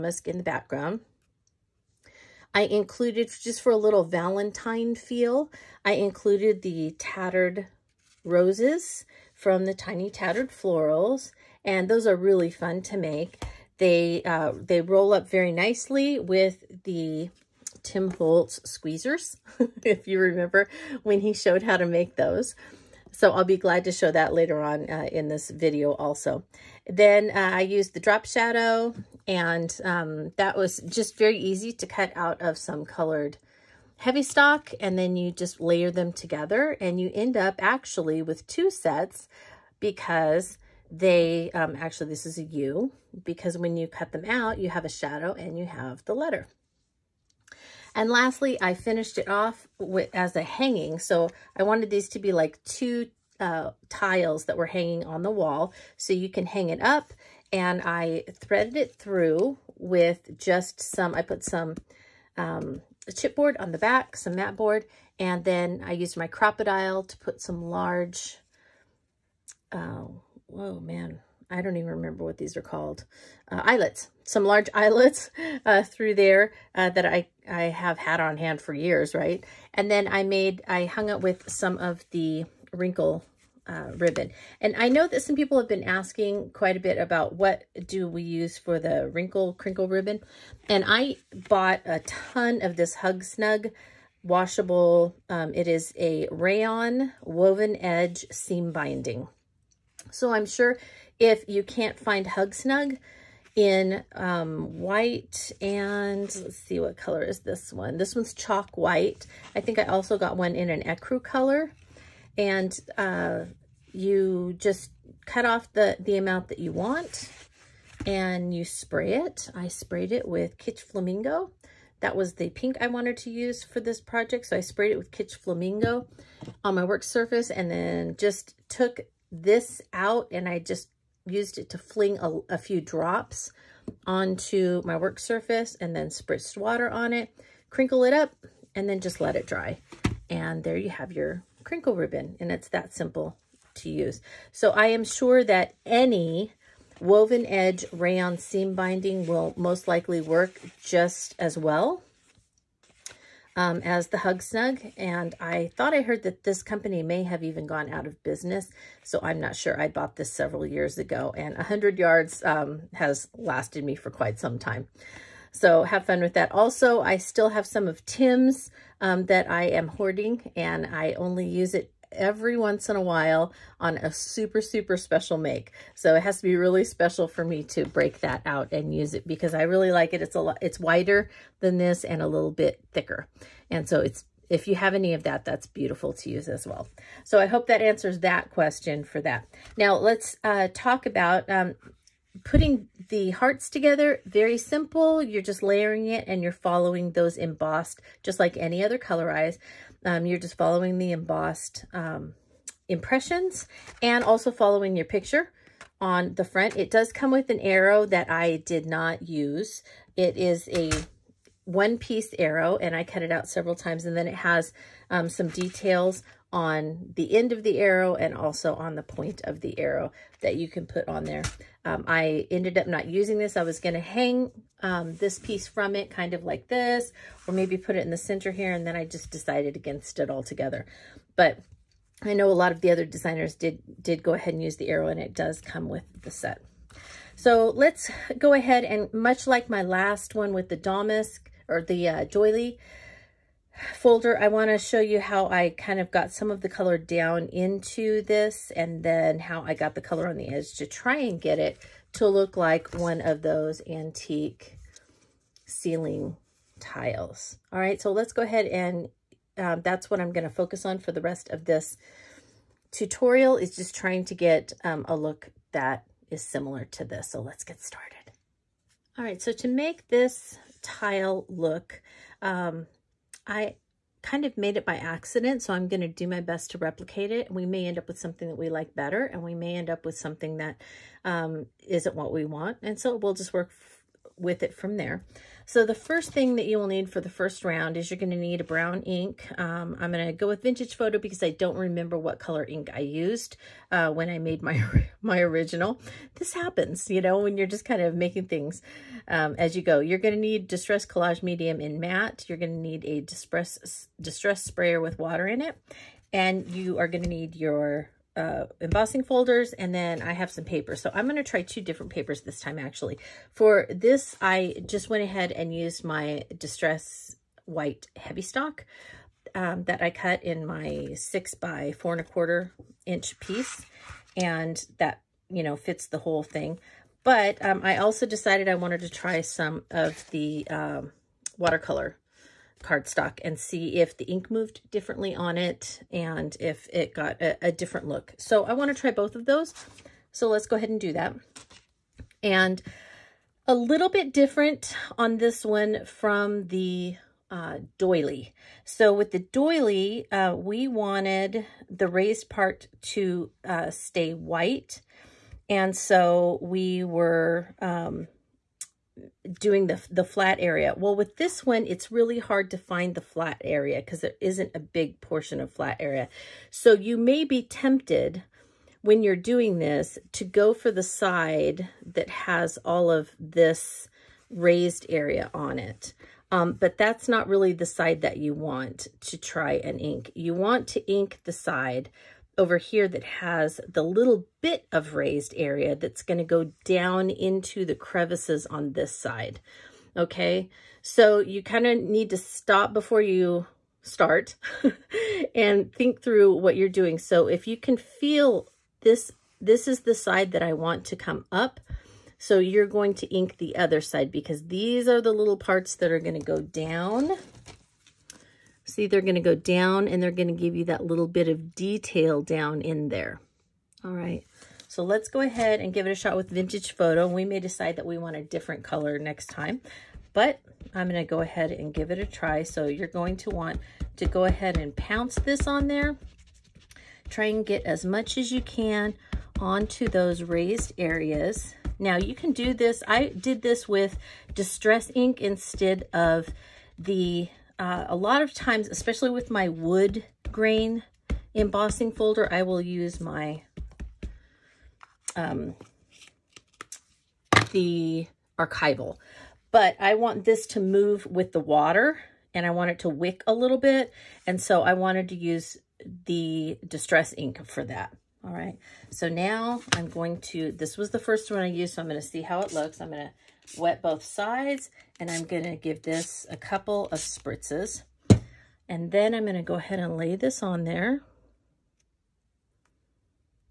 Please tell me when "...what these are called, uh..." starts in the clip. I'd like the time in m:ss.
1:12.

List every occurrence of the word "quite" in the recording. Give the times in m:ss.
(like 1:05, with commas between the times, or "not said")
1:26, 2:44.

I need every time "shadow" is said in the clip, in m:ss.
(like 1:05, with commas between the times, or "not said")
0:28, 0:44.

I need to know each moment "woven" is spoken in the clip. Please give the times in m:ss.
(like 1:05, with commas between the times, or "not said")
1:37, 2:27.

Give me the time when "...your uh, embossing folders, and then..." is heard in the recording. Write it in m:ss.
5:07.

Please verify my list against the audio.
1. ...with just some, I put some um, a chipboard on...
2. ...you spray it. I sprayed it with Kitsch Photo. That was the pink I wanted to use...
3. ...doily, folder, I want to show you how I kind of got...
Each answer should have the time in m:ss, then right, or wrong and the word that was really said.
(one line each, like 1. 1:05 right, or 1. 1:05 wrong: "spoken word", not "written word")
1. 0:59 right
2. 1:58 wrong: "Flamingo", not "Photo"
3. 4:02 right.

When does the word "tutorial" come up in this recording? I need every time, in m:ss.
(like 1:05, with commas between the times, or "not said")
4:22.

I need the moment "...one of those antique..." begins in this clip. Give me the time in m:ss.
4:12.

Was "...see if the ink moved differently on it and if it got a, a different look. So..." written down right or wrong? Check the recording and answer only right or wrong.
right.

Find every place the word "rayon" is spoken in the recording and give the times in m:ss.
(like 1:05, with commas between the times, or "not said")
1:36, 2:27.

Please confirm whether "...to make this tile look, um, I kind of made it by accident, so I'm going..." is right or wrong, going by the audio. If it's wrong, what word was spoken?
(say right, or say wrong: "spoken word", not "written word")
right.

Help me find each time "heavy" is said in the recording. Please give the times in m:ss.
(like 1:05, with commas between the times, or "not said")
0:33, 5:18.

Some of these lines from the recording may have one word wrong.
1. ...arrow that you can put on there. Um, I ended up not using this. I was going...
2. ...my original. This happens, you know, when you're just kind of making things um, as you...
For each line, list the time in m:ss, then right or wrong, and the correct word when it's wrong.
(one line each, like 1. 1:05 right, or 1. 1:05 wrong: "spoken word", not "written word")
1. 3:39 right
2. 4:55 right.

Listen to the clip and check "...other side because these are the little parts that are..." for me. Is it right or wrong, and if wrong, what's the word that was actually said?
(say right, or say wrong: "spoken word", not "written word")
right.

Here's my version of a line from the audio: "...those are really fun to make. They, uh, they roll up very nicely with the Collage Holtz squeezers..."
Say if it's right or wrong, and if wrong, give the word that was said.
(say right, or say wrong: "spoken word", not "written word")
wrong: "Tim", not "Collage".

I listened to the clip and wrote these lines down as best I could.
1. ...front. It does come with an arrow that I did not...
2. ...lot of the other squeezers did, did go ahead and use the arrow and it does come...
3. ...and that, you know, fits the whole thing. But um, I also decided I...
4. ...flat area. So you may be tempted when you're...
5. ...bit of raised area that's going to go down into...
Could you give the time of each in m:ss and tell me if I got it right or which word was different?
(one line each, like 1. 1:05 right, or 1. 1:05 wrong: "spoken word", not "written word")
1. 3:26 right
2. 3:52 wrong: "designers", not "squeezers"
3. 5:24 right
4. 6:05 right
5. 6:24 right.